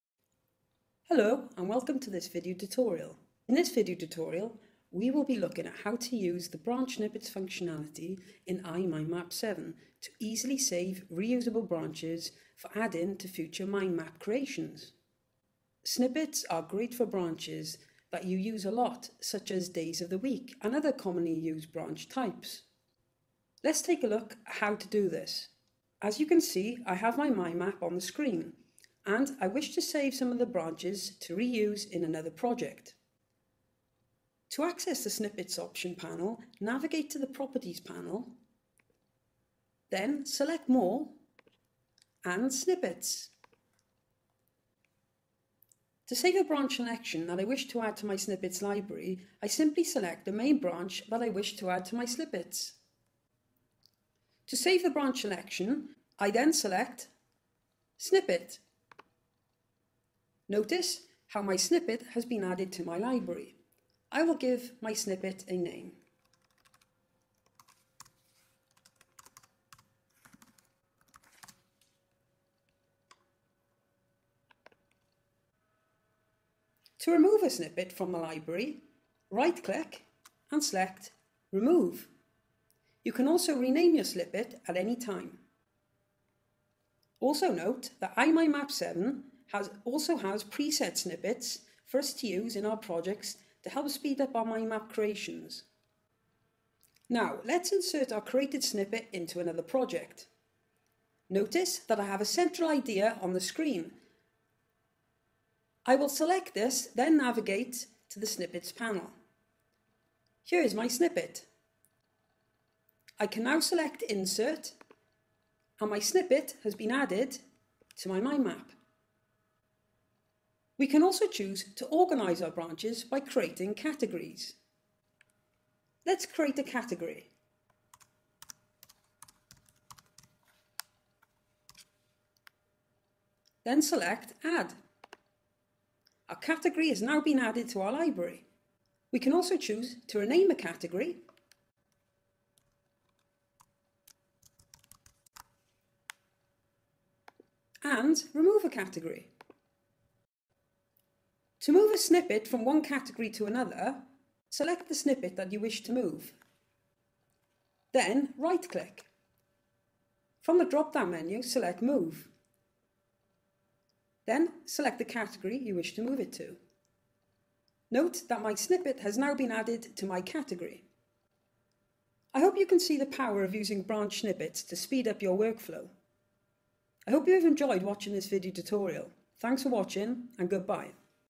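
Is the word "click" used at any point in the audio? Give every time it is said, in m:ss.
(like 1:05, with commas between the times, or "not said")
1:19, 2:38.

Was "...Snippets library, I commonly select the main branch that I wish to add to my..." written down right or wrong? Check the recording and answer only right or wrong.
wrong.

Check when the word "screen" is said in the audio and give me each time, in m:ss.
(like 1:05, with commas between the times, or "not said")
0:28, 1:43.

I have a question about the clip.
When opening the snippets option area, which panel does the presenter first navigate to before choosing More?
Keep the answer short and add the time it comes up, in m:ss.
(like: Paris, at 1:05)
Properties panel, at 0:37.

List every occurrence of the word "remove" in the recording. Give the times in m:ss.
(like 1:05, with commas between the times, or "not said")
1:17, 1:21, 2:28.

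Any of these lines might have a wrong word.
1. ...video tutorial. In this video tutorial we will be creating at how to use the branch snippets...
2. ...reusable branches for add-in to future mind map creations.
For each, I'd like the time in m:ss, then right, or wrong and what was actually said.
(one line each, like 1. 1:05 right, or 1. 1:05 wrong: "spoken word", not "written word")
1. 0:02 wrong: "looking", not "creating"
2. 0:11 right.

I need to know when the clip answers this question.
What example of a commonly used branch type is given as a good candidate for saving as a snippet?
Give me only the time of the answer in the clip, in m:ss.
0:19.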